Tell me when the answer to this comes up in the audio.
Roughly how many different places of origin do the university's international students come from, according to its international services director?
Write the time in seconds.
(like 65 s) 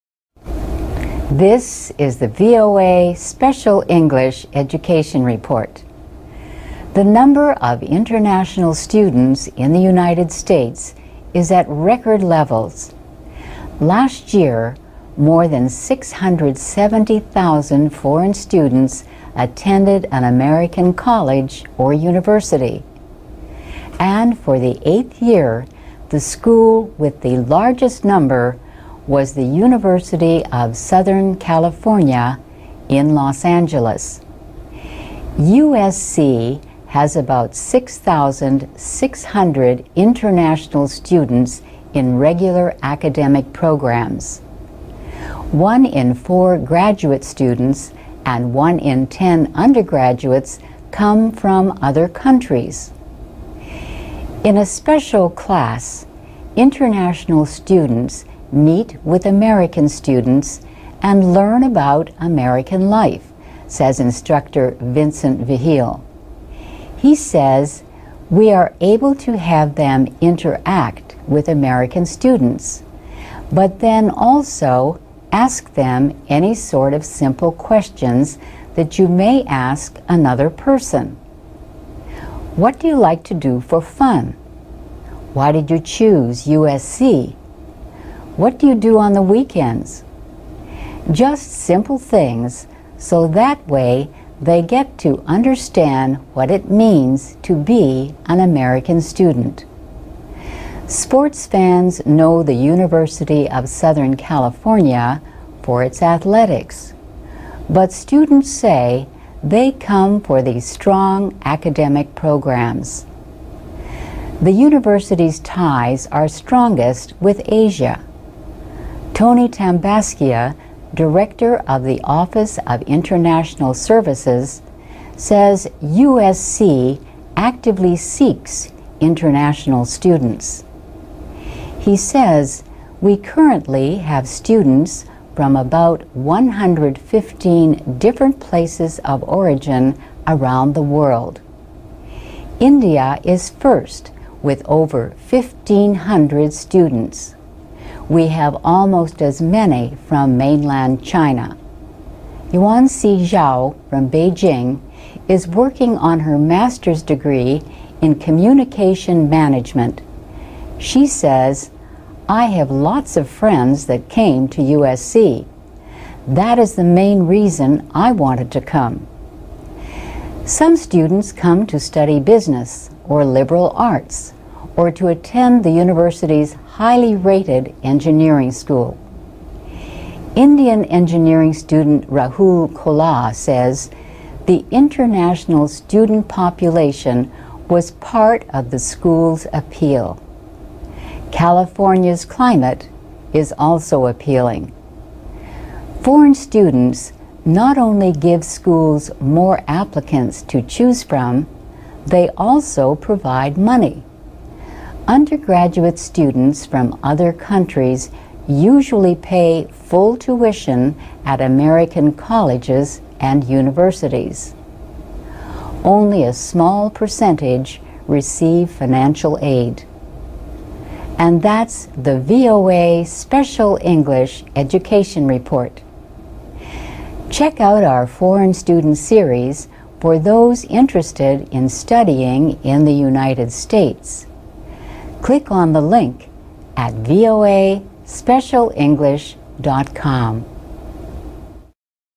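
136 s.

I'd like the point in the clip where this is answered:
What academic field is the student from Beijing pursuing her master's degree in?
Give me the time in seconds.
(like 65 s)
158 s.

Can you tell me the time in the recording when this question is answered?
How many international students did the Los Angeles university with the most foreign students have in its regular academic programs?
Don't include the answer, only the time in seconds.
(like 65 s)
37 s.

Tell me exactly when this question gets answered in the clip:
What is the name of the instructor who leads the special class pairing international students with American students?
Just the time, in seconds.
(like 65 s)
64 s.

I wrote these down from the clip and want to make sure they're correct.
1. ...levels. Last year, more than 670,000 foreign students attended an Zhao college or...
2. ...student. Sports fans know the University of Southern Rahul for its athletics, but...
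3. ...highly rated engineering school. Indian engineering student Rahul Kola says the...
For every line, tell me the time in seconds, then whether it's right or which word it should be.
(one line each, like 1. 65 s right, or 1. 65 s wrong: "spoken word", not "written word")
1. 12 s wrong: "American", not "Zhao"
2. 98 s wrong: "California", not "Rahul"
3. 176 s right.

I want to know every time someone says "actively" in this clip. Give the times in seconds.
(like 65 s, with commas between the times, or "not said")
127 s.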